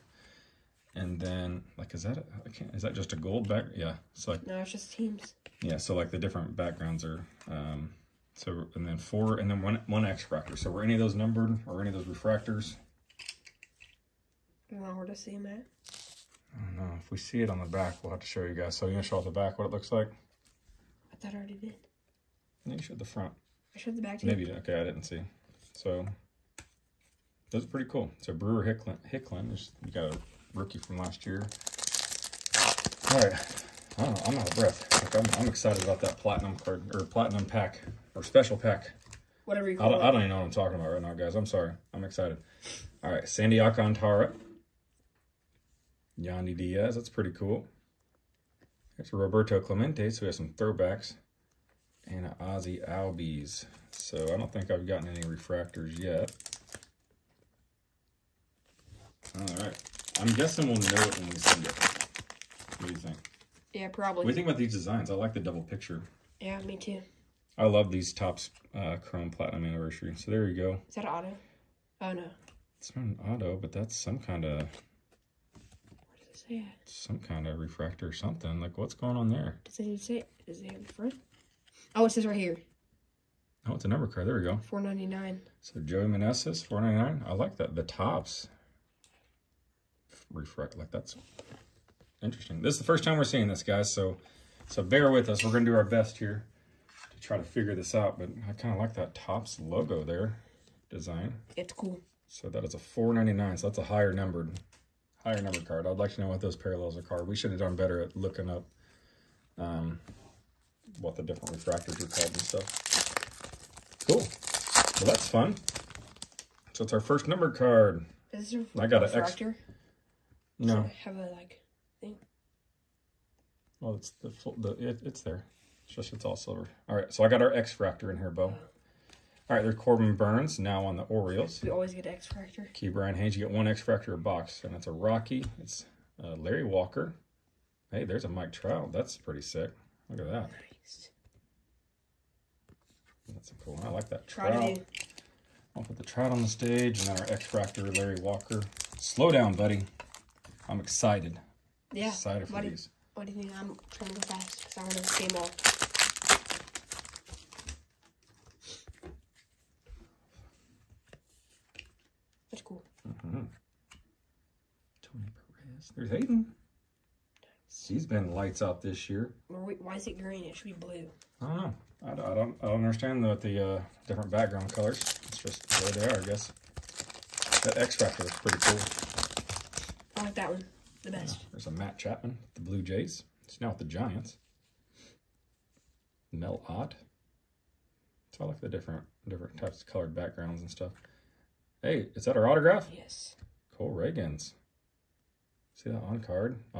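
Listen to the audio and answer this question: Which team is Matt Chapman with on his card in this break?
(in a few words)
Blue Jays.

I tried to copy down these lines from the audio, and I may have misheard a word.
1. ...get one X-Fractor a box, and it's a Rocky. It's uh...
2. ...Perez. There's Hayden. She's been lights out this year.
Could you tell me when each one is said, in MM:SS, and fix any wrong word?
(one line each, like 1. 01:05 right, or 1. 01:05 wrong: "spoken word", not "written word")
1. 02:13 right
2. 02:45 right.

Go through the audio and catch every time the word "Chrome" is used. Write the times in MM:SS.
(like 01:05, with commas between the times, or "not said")
01:09.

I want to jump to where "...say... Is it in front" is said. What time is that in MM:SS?
01:19.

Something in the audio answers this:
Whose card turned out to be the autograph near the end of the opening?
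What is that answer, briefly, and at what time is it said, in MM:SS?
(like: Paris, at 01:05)
Cole Ragans, at 03:13.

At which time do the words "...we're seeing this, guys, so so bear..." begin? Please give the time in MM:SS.
01:33.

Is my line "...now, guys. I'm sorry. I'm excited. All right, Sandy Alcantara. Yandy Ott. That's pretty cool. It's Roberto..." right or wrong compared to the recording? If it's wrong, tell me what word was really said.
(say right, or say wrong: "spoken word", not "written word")
wrong: "Diaz", not "Ott".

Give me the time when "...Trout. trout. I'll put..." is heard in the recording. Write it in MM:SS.
02:24.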